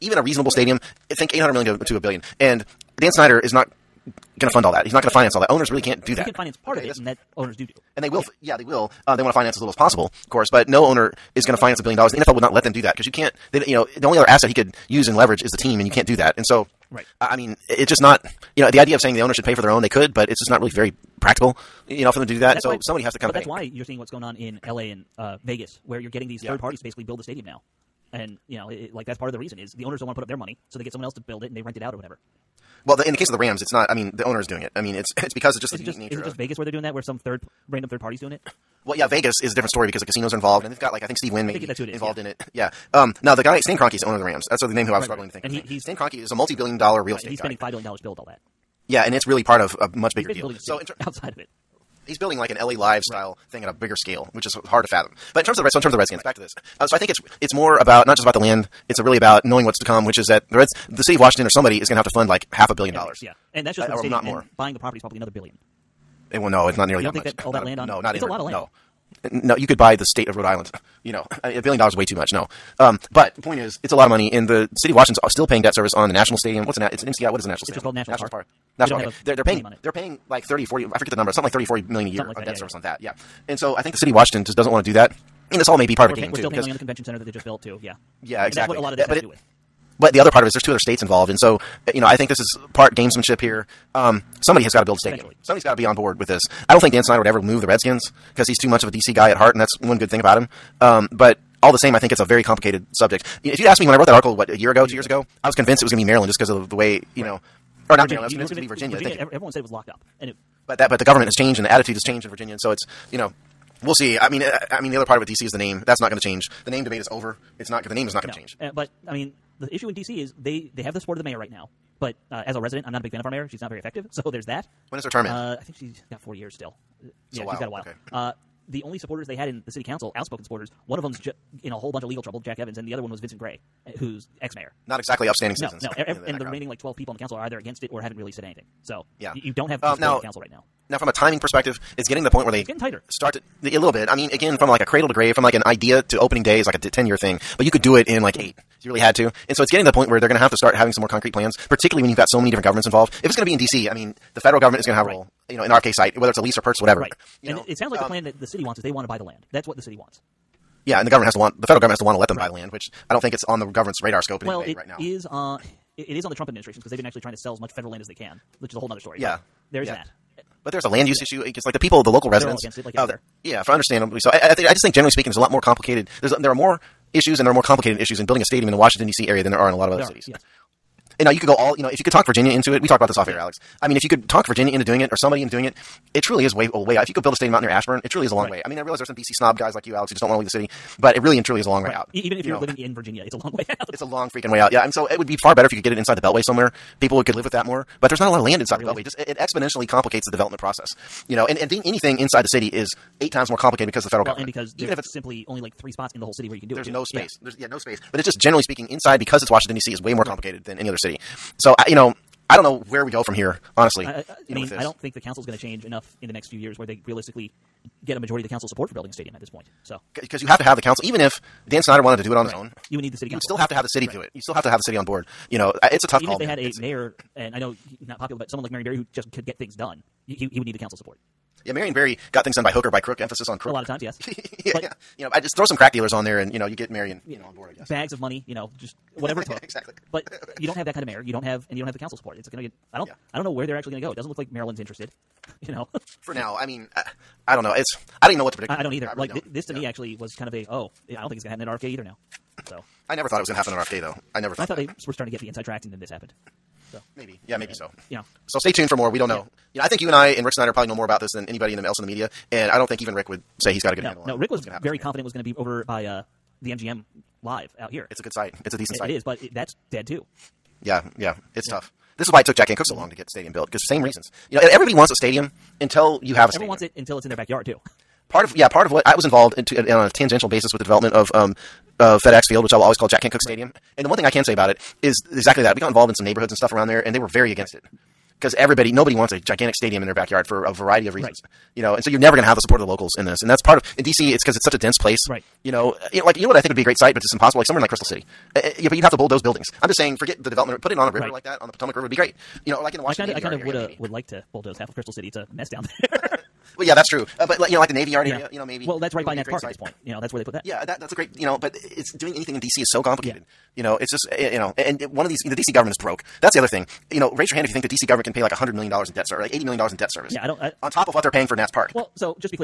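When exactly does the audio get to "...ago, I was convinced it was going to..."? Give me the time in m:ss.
1:45.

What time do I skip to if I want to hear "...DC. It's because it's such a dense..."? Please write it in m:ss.
4:54.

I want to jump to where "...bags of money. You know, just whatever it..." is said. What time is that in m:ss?
3:57.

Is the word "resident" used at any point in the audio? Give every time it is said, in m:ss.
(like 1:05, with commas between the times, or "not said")
2:02, 2:52.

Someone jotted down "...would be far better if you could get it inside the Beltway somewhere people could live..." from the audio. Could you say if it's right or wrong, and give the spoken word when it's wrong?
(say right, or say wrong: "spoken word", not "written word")
right.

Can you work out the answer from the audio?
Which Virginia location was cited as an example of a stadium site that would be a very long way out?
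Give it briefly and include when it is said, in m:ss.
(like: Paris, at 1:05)
Ashburn, at 3:07.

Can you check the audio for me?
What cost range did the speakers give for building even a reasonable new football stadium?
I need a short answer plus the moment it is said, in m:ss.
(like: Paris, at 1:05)
$800 million to $1 billion, at 0:01.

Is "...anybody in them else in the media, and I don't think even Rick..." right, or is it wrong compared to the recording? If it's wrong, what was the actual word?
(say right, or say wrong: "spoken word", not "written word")
right.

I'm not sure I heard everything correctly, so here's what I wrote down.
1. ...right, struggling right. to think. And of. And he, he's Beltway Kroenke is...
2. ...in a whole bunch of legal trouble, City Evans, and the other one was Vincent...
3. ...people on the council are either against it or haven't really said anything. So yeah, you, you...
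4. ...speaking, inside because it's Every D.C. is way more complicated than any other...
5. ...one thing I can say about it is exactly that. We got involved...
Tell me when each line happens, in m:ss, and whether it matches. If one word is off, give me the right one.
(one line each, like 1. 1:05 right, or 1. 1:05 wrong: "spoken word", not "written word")
1. 0:45 wrong: "Stan", not "Beltway"
2. 2:11 wrong: "Jack", not "City"
3. 2:16 right
4. 3:28 wrong: "Washington", not "Every"
5. 4:44 right.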